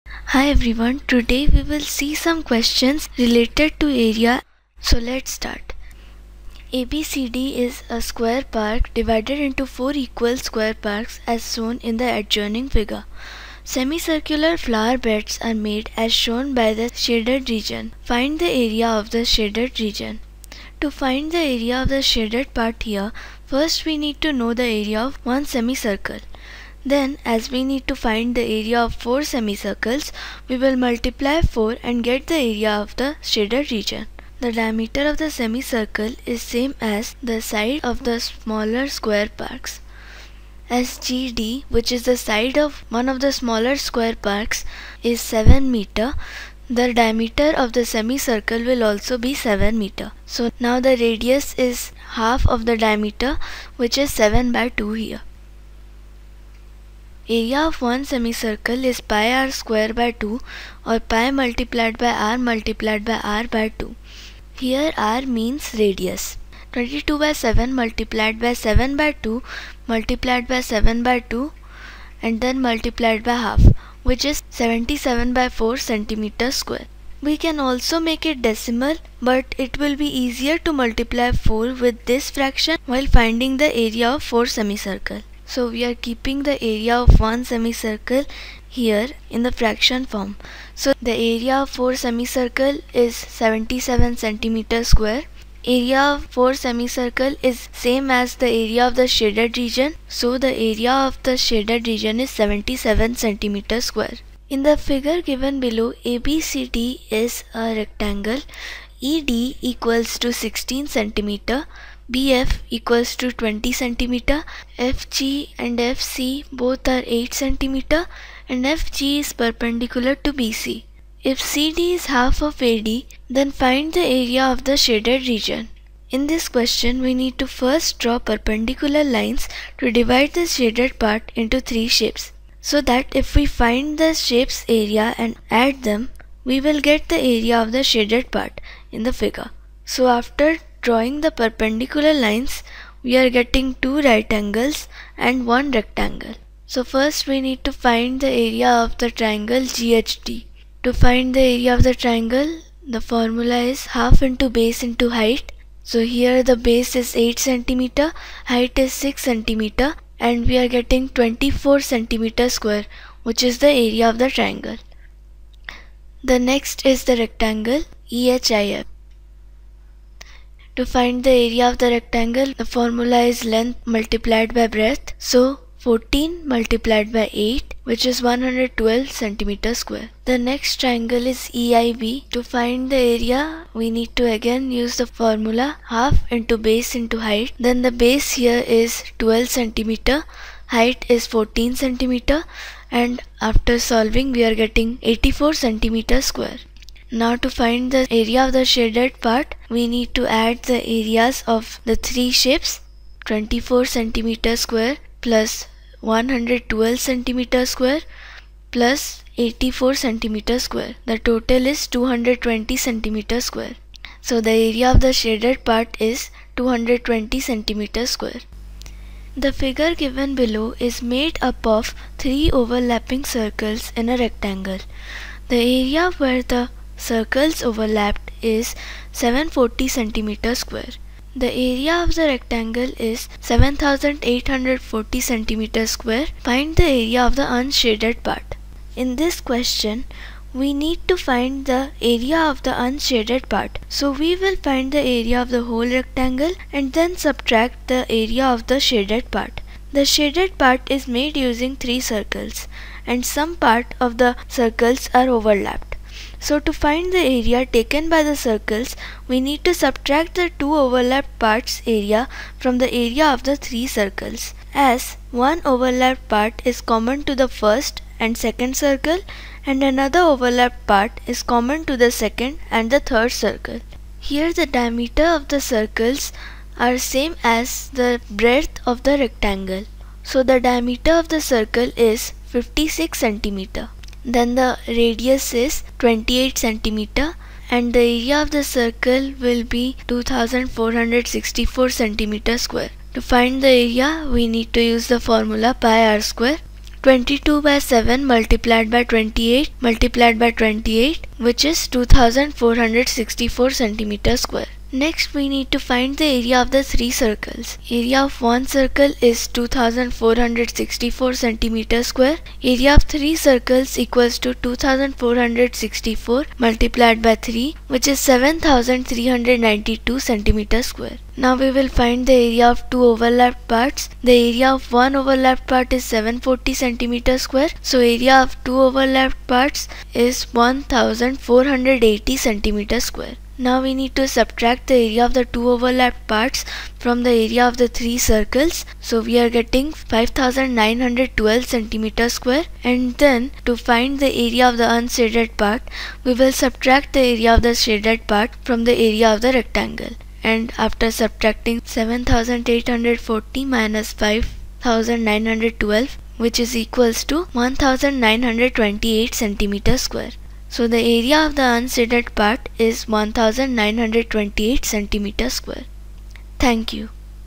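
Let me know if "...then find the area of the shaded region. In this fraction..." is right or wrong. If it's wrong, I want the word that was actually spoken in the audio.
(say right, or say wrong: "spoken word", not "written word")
wrong: "question", not "fraction".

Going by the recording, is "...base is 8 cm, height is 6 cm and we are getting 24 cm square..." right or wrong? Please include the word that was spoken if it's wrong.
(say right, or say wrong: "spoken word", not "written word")
right.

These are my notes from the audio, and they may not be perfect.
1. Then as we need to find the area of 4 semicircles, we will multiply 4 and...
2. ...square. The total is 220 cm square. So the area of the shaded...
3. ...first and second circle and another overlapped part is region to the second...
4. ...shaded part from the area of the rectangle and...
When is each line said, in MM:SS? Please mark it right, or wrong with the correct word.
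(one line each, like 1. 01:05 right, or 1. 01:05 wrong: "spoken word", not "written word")
1. 00:26 right
2. 03:30 right
3. 04:27 wrong: "common", not "region"
4. 05:47 right.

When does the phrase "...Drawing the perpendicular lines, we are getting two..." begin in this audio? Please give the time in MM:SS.
02:20.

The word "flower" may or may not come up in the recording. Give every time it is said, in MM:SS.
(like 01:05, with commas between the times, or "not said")
00:14.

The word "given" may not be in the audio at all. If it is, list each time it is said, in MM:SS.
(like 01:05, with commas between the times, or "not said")
01:45, 03:39.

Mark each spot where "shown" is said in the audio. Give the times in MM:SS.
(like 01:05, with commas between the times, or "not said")
00:11, 00:16.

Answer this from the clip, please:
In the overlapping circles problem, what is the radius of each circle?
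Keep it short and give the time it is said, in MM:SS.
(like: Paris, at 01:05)
28 cm, at 04:45.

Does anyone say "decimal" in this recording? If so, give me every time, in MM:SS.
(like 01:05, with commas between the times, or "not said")
01:18.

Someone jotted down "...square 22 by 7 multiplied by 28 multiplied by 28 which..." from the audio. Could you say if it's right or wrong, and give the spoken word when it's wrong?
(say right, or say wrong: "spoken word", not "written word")
right.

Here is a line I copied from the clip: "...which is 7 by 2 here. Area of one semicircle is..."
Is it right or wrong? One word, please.
right.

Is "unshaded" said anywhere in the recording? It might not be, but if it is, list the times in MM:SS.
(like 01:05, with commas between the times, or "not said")
03:57, 04:02, 05:44, 06:01.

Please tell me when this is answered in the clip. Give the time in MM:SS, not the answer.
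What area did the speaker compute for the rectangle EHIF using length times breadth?
02:58.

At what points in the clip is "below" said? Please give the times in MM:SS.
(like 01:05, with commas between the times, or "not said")
01:45, 03:40.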